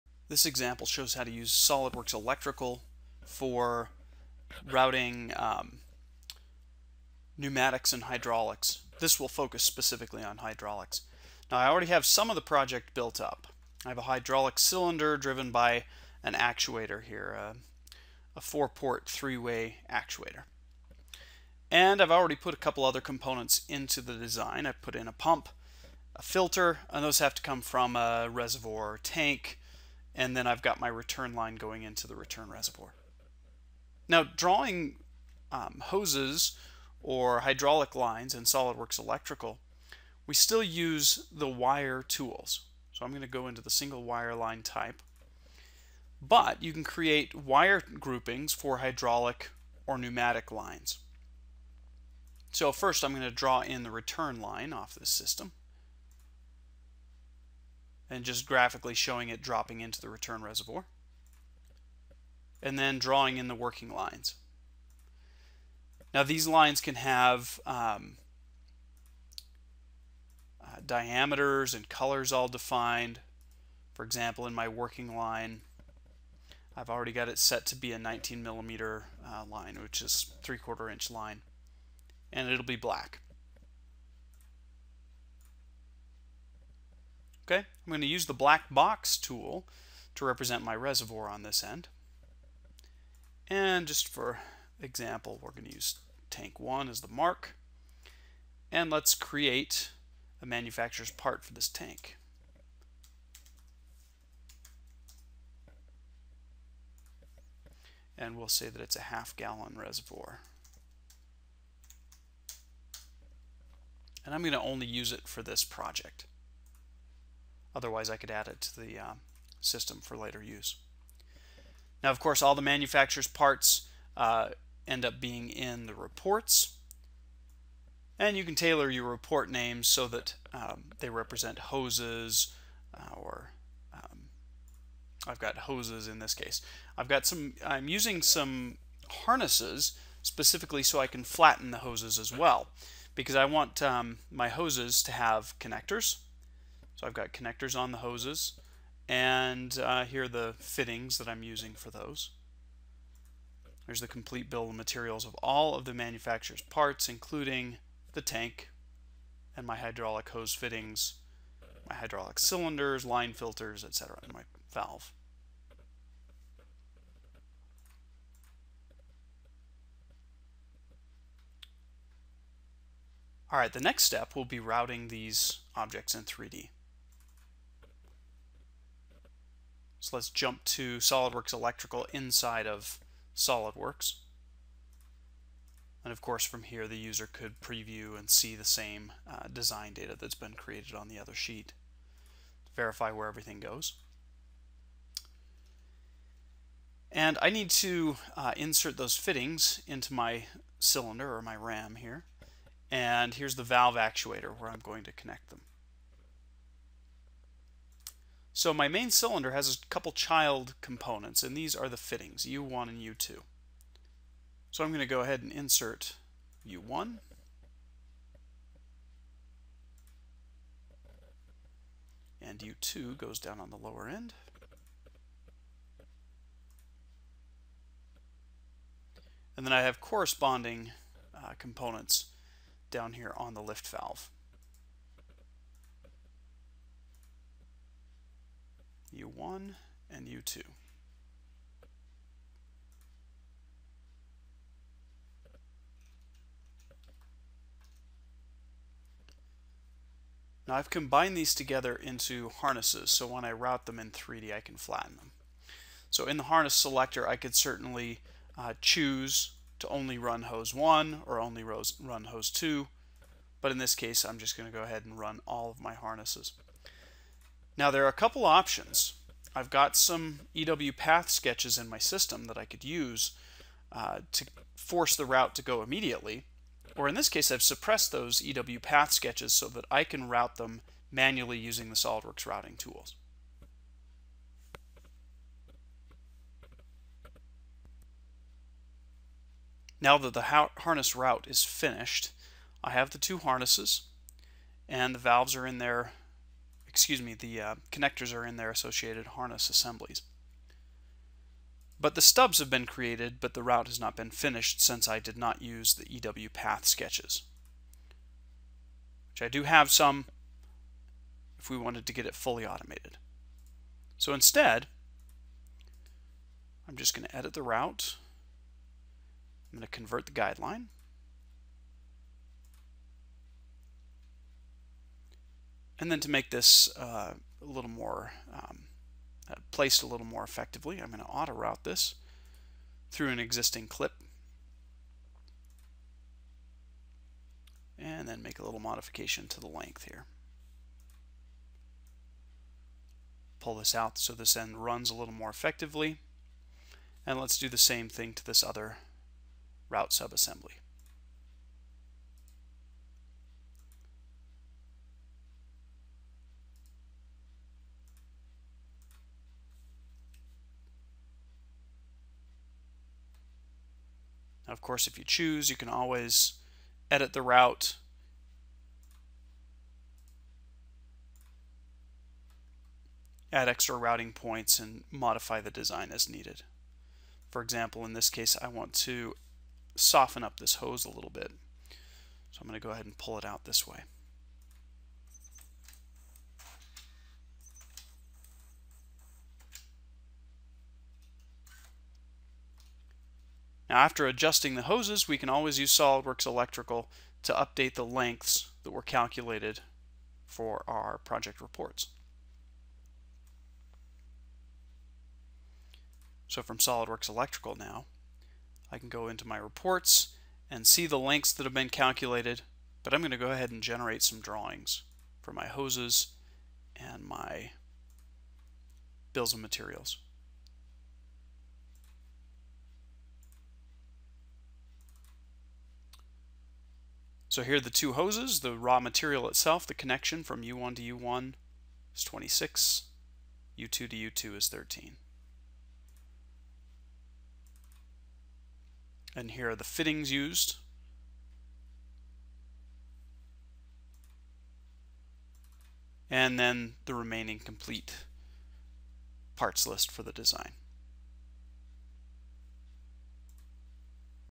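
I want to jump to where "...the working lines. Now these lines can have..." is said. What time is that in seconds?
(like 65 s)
63 s.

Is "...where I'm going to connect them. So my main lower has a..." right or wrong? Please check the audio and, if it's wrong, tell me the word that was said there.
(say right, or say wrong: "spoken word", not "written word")
wrong: "cylinder", not "lower".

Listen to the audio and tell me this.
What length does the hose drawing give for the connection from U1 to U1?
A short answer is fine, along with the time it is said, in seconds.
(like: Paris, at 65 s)
26, at 432 s.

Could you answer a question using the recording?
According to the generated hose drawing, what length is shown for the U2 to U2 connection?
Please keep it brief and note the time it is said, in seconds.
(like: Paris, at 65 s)
13, at 434 s.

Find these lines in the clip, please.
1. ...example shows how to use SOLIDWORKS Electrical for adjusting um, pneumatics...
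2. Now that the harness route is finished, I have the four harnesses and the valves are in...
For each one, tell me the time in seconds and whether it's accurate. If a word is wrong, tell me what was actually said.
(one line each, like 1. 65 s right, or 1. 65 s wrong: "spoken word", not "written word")
1. 0 s wrong: "routing", not "adjusting"
2. 289 s wrong: "two", not "four".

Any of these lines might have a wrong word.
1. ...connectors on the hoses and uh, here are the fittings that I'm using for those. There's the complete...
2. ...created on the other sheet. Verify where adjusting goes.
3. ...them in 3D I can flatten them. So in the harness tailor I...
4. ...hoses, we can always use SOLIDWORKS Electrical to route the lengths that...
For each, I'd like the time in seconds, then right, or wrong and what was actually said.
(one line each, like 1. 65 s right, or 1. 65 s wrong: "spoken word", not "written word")
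1. 147 s right
2. 190 s wrong: "everything", not "adjusting"
3. 253 s wrong: "selector", not "tailor"
4. 394 s wrong: "update", not "route".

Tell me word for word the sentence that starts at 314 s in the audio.
So instead, I'm just going to edit the route.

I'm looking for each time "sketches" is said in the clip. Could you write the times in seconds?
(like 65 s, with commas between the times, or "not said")
271 s, 279 s, 306 s.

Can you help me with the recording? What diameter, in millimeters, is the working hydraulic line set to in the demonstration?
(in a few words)
19 millimeters.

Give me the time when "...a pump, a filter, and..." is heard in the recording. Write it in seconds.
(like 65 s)
25 s.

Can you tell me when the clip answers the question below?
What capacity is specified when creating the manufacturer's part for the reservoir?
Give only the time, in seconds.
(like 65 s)
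109 s.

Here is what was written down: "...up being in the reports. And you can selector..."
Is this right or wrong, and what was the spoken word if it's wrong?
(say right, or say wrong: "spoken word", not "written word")
wrong: "tailor", not "selector".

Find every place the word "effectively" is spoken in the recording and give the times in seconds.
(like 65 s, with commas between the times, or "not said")
330 s, 345 s.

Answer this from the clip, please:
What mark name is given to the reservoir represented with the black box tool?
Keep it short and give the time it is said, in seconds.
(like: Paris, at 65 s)
tank 1, at 96 s.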